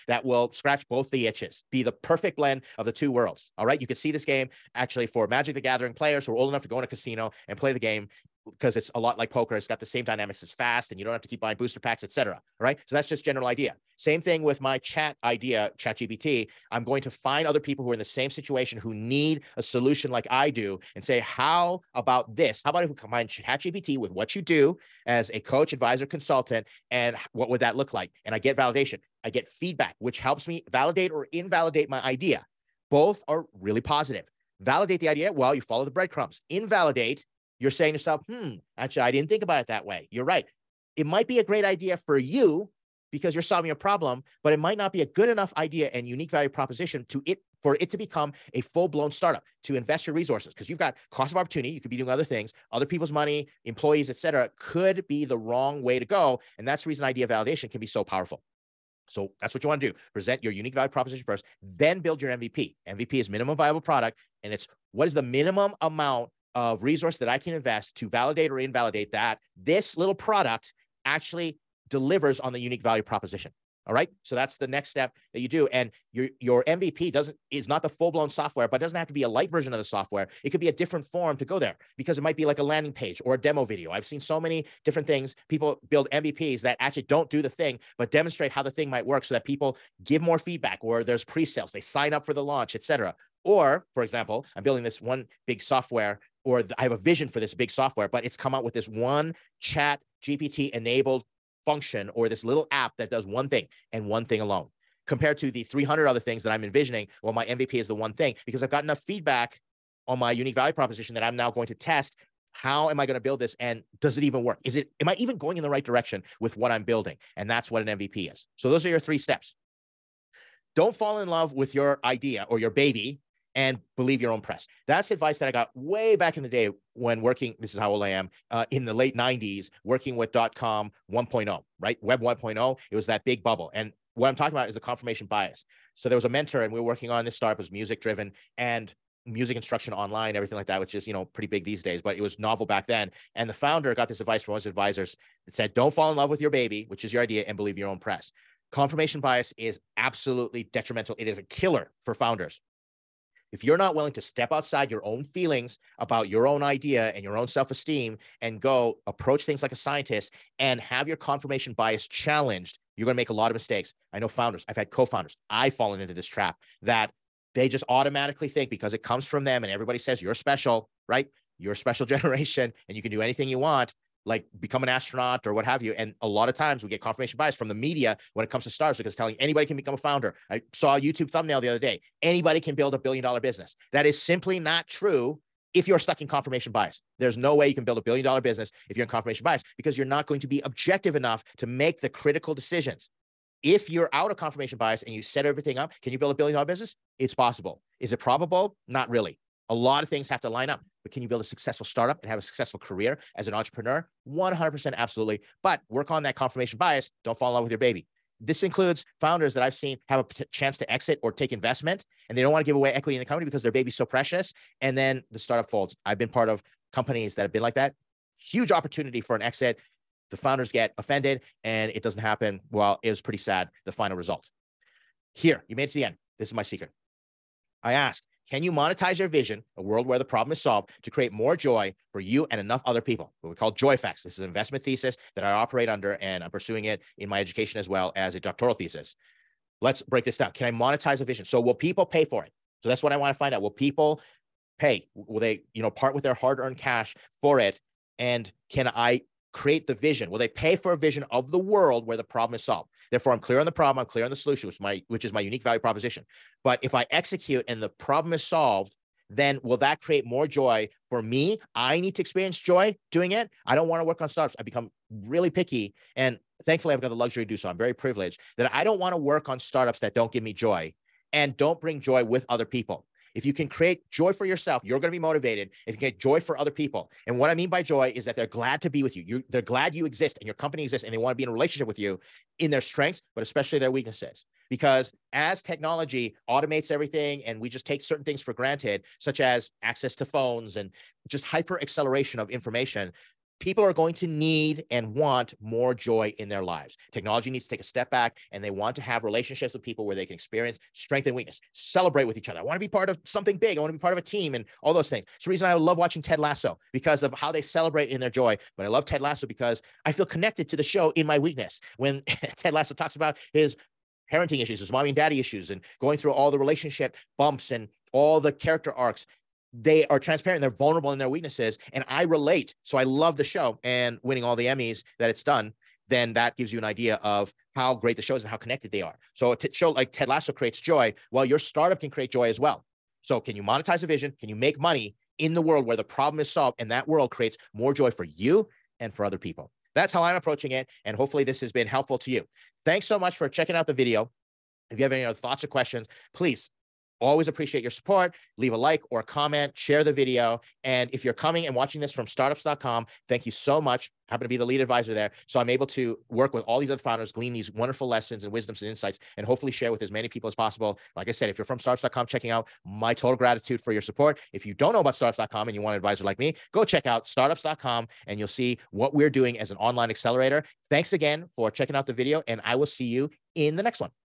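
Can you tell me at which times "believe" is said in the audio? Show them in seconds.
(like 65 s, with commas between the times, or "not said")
123 s, 147 s.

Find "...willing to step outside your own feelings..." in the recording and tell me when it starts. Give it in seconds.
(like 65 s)
153 s.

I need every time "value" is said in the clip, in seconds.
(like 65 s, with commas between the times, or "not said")
46 s, 60 s, 72 s, 110 s, 255 s.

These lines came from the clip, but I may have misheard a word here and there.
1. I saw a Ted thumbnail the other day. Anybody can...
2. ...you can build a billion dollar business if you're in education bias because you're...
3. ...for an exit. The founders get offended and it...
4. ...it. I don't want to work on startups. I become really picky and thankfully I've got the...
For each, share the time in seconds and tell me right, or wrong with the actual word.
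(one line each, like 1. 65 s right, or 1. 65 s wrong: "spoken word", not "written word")
1. 180 s wrong: "YouTube", not "Ted"
2. 187 s wrong: "confirmation", not "education"
3. 219 s right
4. 263 s right.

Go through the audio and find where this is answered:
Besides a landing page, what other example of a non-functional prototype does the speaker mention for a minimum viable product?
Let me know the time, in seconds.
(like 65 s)
83 s.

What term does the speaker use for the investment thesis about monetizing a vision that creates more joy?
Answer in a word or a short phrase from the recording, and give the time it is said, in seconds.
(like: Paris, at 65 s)
joy effects, at 233 s.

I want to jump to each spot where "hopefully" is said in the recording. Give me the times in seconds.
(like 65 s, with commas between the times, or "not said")
341 s, 359 s.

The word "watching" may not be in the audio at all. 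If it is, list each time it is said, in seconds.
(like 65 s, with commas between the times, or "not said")
305 s, 351 s.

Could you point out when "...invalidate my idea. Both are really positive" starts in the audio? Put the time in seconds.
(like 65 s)
31 s.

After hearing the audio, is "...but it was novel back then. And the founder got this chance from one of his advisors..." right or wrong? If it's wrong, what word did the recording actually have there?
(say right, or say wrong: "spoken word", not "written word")
wrong: "advice", not "chance".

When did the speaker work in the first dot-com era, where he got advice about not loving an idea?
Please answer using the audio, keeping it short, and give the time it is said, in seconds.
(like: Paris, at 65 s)
late 90s, at 128 s.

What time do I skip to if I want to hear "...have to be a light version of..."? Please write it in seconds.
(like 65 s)
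78 s.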